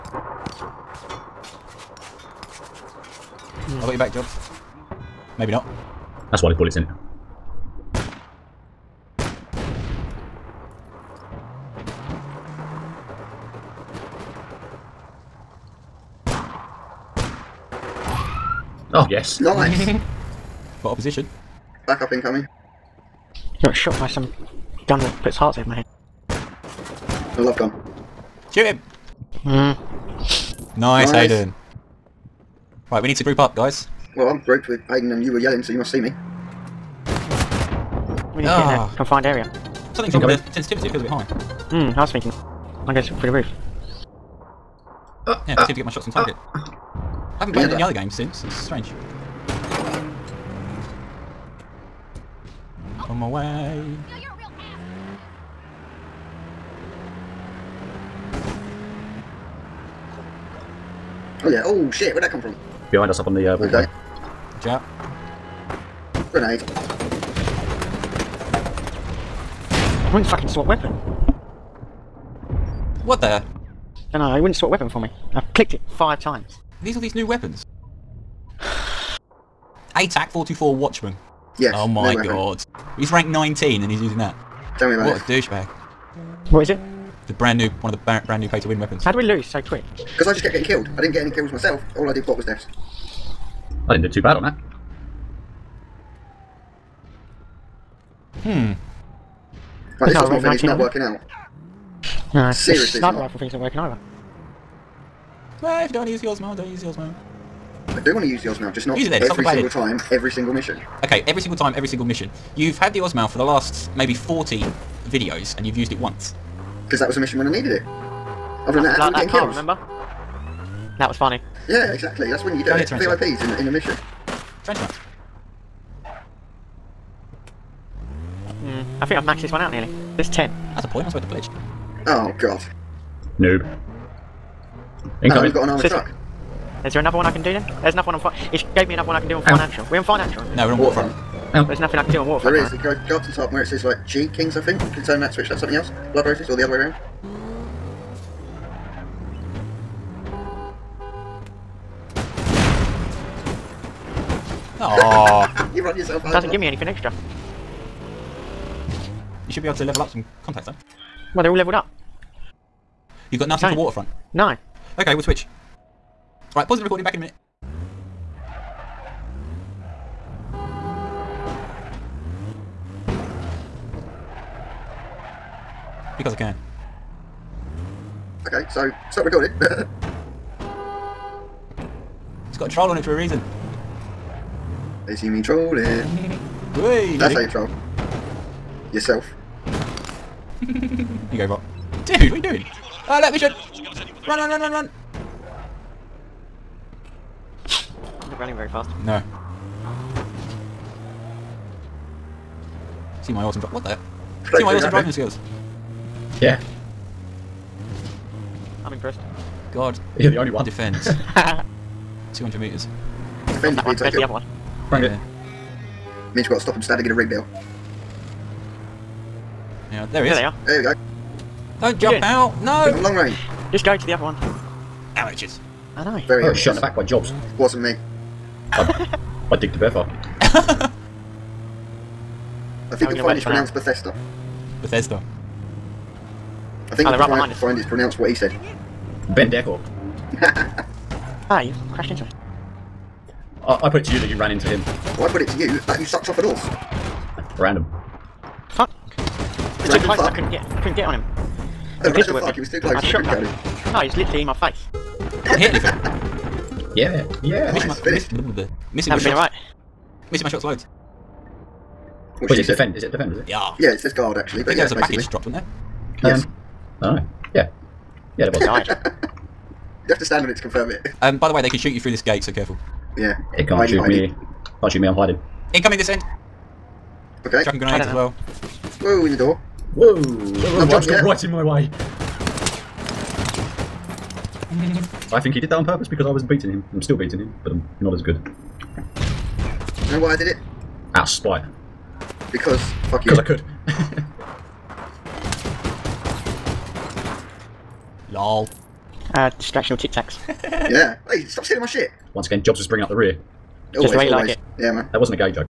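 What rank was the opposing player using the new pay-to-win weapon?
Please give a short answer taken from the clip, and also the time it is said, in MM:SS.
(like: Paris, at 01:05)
19, at 01:23.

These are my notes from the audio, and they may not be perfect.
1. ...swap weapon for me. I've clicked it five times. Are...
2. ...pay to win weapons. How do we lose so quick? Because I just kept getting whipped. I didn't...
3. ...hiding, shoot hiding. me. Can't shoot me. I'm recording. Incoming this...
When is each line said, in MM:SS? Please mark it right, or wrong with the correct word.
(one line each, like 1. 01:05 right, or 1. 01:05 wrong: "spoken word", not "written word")
1. 01:14 right
2. 01:28 wrong: "killed", not "whipped"
3. 04:33 wrong: "hiding", not "recording".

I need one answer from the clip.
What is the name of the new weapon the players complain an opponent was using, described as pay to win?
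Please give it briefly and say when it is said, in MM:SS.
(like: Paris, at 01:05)
TAC 424 Watchman, at 01:20.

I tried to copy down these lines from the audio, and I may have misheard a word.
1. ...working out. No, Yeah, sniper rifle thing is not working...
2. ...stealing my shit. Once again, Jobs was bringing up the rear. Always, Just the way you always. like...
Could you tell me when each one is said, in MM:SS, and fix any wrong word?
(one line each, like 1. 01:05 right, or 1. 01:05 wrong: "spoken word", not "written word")
1. 01:40 wrong: "Seriously", not "Yeah"
2. 05:01 right.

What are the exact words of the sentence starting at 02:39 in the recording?
You should be able to level up some contacts though.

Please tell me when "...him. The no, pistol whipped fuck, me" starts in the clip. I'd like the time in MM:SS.
04:11.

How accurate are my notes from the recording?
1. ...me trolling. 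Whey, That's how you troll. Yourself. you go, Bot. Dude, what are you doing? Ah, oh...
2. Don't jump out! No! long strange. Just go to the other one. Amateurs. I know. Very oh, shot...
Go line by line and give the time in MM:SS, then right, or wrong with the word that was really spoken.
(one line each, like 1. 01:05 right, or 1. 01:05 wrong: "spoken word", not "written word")
1. 03:05 right
2. 03:41 wrong: "range", not "strange".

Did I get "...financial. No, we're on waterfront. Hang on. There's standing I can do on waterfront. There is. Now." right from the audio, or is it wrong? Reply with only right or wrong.
wrong.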